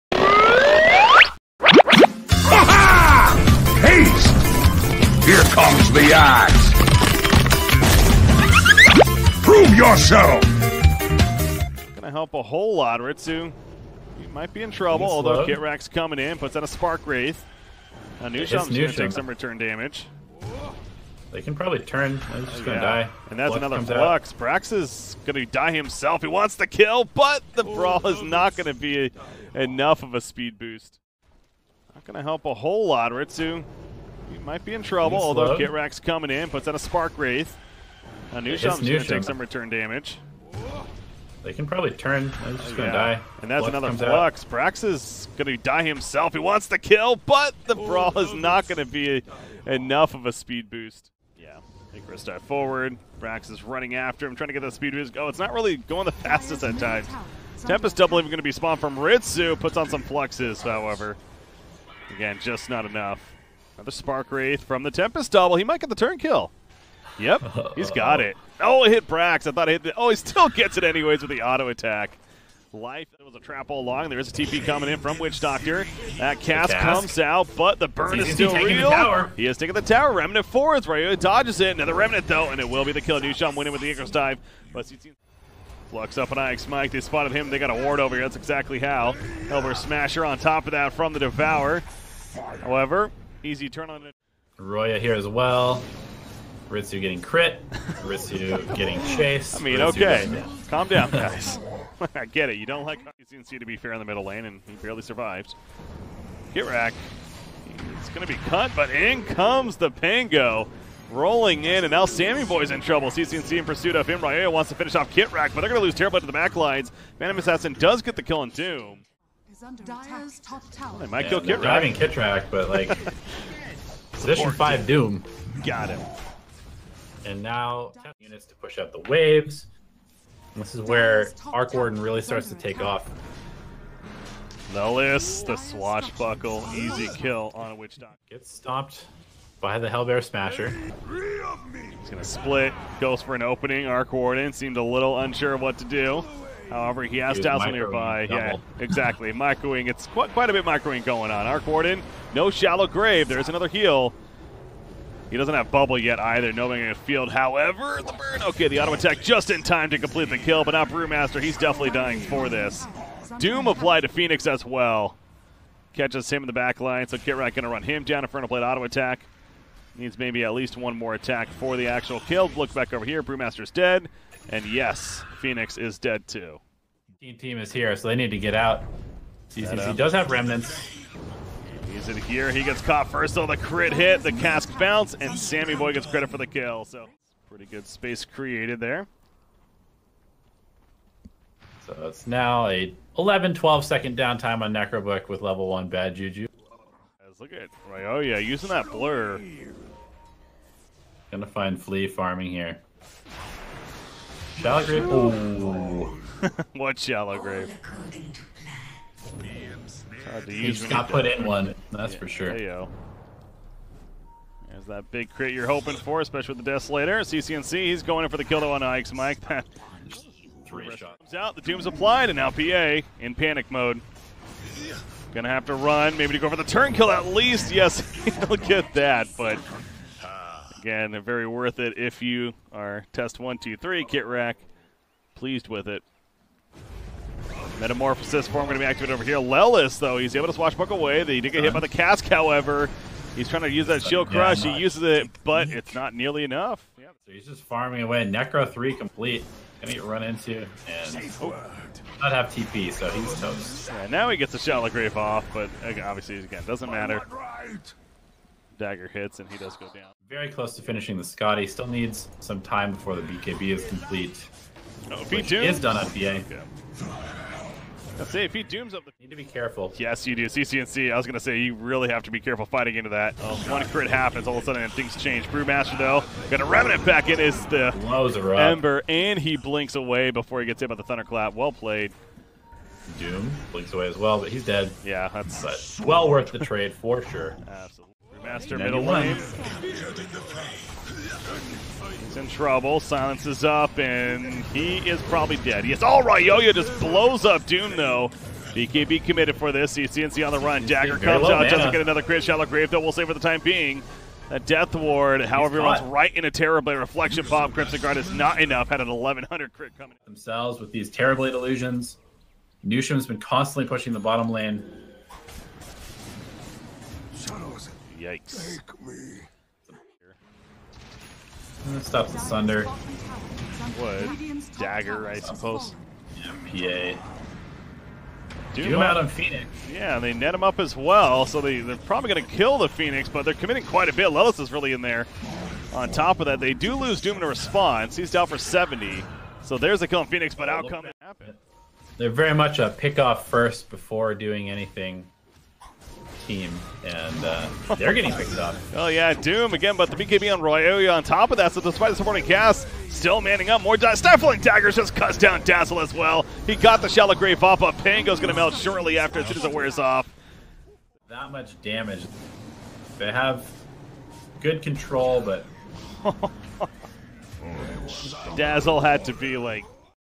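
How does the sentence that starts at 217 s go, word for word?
CCNC, he's going in for the kill though on Ix Mike.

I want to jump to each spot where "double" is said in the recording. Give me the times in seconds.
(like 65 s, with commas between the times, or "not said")
57 s, 65 s, 148 s.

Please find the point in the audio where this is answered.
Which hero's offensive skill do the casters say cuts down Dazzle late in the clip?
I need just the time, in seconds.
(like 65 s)
354 s.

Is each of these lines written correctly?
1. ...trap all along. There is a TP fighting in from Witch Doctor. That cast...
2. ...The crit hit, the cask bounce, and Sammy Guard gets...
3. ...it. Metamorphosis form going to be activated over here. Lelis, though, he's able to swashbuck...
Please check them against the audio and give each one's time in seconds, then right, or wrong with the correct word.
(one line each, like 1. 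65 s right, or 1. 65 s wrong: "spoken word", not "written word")
1. 73 s wrong: "coming", not "fighting"
2. 183 s wrong: "Boy", not "Guard"
3. 235 s right.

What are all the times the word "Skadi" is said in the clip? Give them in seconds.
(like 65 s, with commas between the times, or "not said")
261 s.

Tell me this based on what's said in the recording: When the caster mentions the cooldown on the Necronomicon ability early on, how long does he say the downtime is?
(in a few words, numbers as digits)
11, 12 seconds.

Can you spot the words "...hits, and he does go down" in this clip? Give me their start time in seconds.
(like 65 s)
259 s.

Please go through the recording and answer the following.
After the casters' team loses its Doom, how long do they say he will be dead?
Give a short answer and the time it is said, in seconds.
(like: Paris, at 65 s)
70, at 338 s.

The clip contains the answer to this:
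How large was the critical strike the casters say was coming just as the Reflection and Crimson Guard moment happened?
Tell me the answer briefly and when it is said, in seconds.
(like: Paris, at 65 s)
1100, at 309 s.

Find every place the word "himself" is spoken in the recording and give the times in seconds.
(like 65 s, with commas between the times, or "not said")
25 s, 45 s.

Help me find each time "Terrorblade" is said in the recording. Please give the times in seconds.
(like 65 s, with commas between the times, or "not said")
115 s, 306 s, 311 s.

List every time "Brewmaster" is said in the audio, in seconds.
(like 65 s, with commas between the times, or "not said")
160 s, 173 s, 275 s.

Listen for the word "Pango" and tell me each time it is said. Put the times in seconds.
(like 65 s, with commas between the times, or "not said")
109 s, 357 s.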